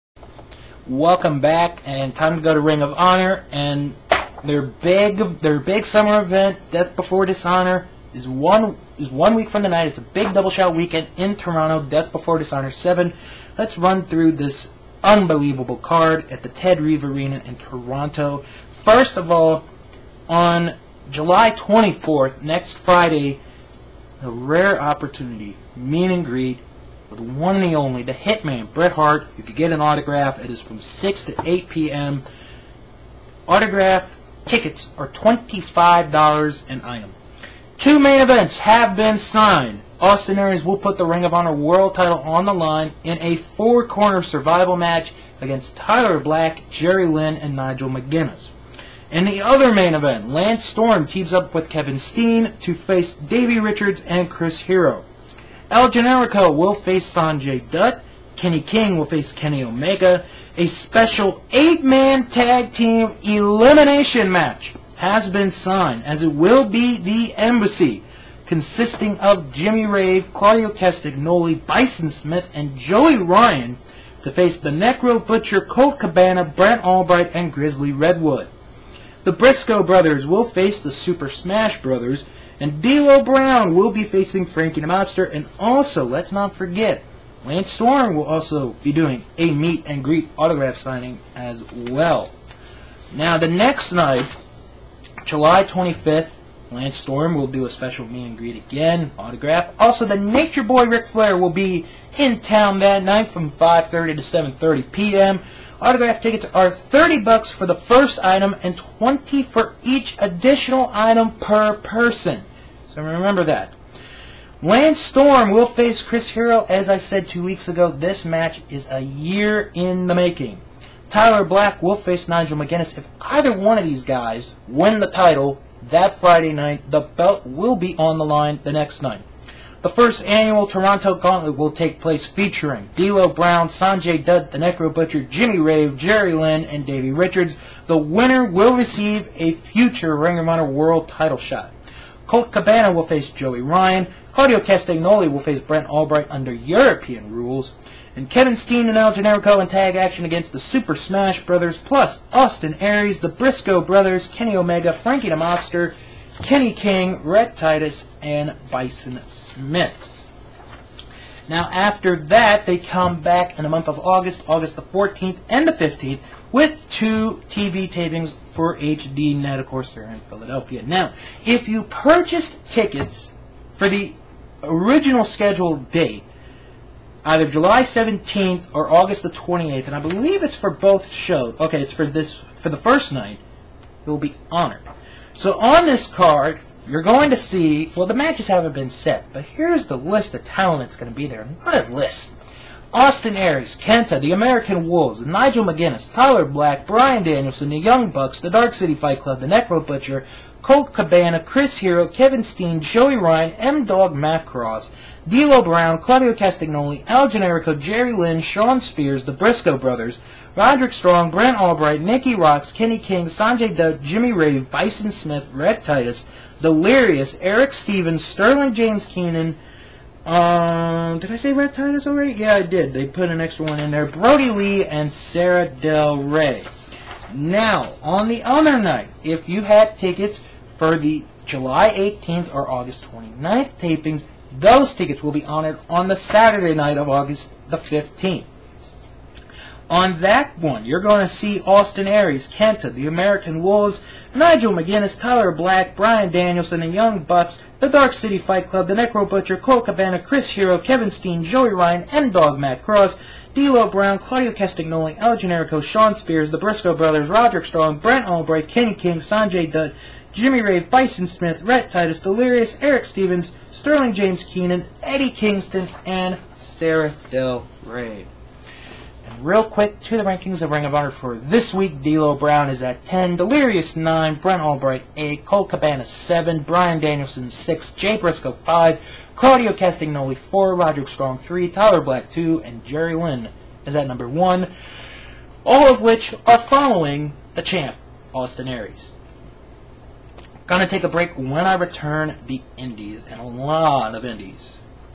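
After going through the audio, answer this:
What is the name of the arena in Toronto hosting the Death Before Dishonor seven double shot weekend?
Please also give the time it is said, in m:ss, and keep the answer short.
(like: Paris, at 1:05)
Ted Reeve Arena, at 0:16.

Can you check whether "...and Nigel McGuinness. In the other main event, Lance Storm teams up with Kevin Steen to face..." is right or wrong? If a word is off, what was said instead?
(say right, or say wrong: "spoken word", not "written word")
right.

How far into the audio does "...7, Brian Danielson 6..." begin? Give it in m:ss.
4:36.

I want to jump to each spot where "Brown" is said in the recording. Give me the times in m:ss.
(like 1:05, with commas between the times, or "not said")
1:23, 2:13, 3:25, 4:13, 4:32.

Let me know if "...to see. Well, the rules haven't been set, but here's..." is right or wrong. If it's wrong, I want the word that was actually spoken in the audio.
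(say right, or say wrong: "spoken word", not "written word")
wrong: "matches", not "rules".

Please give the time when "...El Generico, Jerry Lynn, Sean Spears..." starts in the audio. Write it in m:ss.
3:27.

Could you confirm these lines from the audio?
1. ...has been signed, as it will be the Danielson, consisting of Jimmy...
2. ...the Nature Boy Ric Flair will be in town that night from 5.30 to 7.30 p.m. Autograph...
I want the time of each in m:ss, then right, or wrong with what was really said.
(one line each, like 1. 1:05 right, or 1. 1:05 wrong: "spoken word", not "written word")
1. 1:04 wrong: "Embassy", not "Danielson"
2. 1:40 right.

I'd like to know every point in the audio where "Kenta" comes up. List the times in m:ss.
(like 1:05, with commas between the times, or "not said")
3:13, 4:02.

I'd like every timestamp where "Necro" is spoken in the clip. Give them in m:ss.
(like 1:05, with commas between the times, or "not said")
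1:14, 2:14, 3:19, 4:08.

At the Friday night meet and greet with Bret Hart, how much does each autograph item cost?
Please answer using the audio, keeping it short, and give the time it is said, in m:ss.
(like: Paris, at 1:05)
$25, at 0:35.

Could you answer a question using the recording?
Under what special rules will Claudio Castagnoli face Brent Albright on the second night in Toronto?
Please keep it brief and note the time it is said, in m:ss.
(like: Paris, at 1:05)
European rules, at 2:26.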